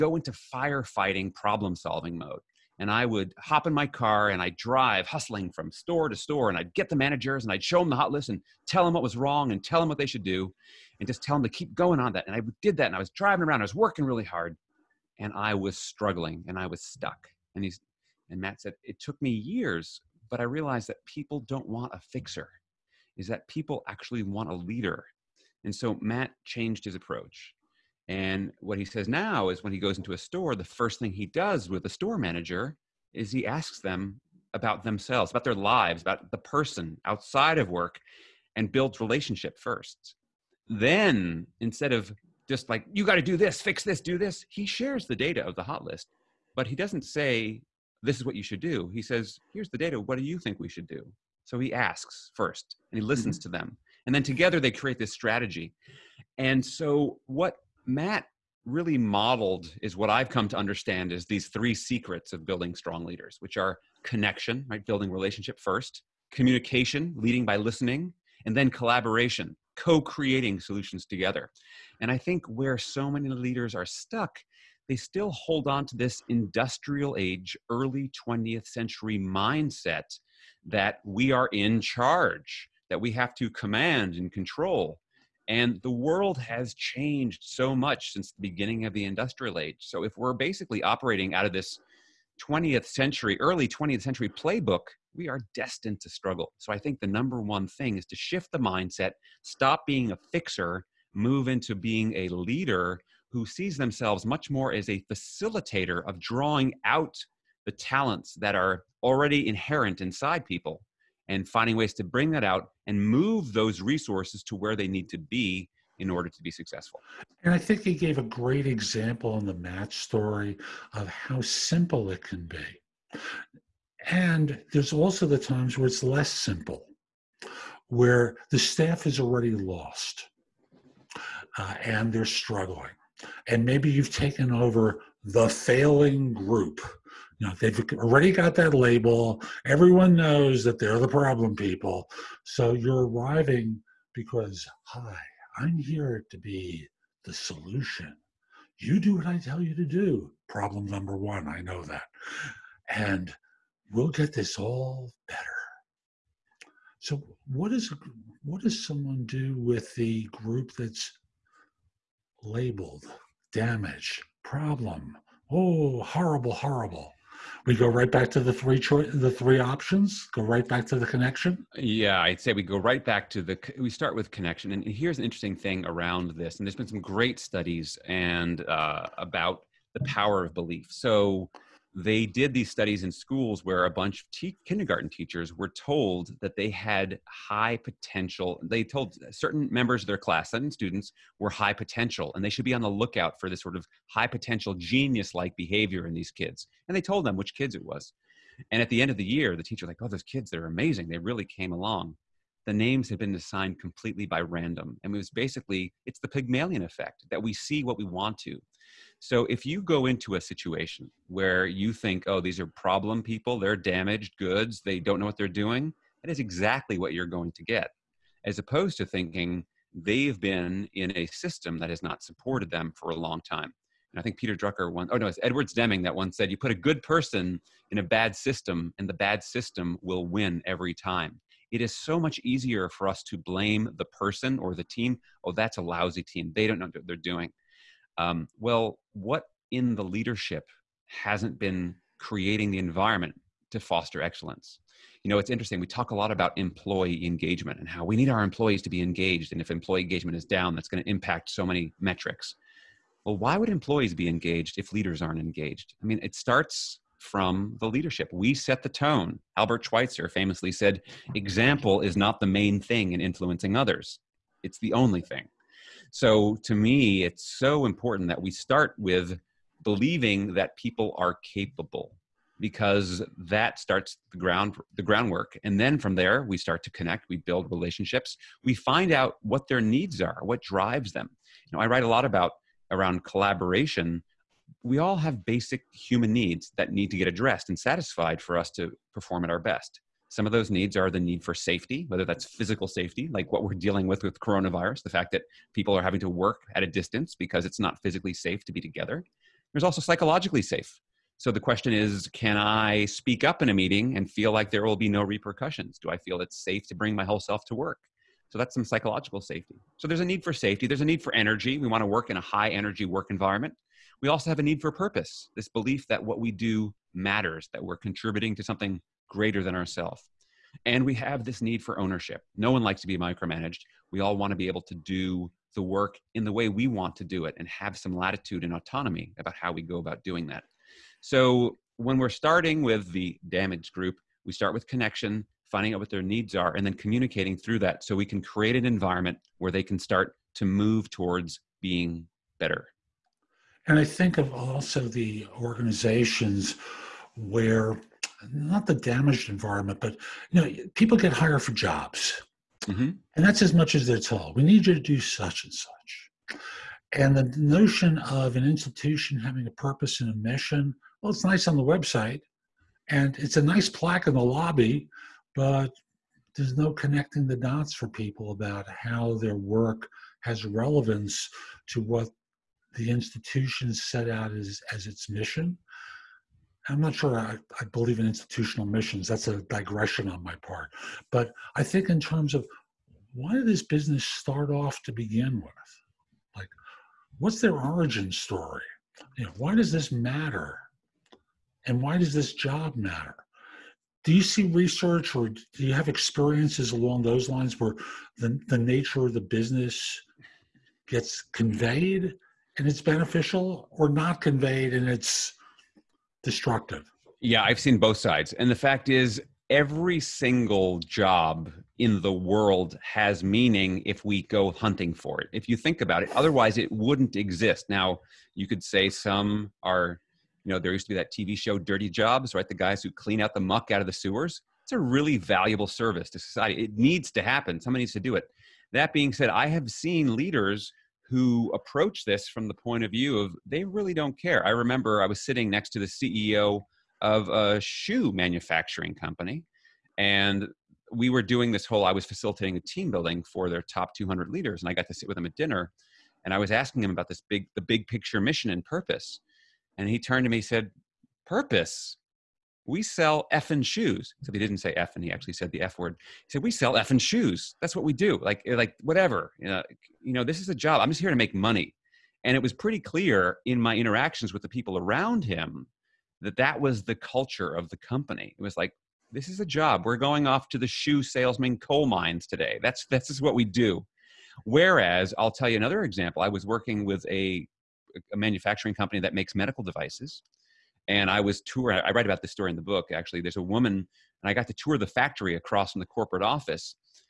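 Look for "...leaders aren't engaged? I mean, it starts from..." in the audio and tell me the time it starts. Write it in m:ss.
4:14.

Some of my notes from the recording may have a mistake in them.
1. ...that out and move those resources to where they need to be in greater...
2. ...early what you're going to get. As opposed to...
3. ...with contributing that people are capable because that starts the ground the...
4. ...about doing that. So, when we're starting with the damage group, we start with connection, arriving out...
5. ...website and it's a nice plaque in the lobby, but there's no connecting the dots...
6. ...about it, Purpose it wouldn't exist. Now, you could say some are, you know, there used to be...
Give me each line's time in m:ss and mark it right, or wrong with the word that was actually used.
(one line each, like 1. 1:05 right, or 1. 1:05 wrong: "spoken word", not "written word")
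1. 1:52 wrong: "order", not "greater"
2. 3:36 wrong: "exactly", not "early"
3. 4:28 wrong: "believing", not "contributing"
4. 5:29 wrong: "finding", not "arriving"
5. 6:01 right
6. 6:56 wrong: "otherwise", not "Purpose".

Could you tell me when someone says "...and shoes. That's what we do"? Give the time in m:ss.
7:37.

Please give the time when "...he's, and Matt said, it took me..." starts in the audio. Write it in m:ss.
0:17.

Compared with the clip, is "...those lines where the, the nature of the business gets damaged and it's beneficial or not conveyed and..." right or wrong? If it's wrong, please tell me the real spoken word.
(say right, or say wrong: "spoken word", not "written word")
wrong: "conveyed", not "damaged".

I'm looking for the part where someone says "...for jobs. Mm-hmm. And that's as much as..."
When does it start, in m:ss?
5:51.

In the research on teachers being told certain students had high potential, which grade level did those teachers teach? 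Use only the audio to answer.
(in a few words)
kindergarten.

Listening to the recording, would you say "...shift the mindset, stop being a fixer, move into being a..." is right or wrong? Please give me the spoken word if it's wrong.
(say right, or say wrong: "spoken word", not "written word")
right.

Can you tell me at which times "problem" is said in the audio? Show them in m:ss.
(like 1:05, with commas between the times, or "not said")
0:01, 2:21, 2:30, 2:44, 3:32.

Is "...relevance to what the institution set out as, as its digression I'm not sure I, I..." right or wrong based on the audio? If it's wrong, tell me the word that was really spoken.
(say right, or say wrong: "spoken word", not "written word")
wrong: "mission", not "digression".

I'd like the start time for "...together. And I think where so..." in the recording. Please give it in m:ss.
1:11.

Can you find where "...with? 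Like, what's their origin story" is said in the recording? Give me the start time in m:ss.
6:25.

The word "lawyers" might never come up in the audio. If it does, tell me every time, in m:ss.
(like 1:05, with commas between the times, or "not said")
not said.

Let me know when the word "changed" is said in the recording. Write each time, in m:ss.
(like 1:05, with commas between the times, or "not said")
0:26, 1:26.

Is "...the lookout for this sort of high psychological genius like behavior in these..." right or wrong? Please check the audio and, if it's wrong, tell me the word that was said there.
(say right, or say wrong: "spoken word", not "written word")
wrong: "potential", not "psychological".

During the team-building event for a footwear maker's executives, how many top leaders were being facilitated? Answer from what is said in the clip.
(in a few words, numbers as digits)
200.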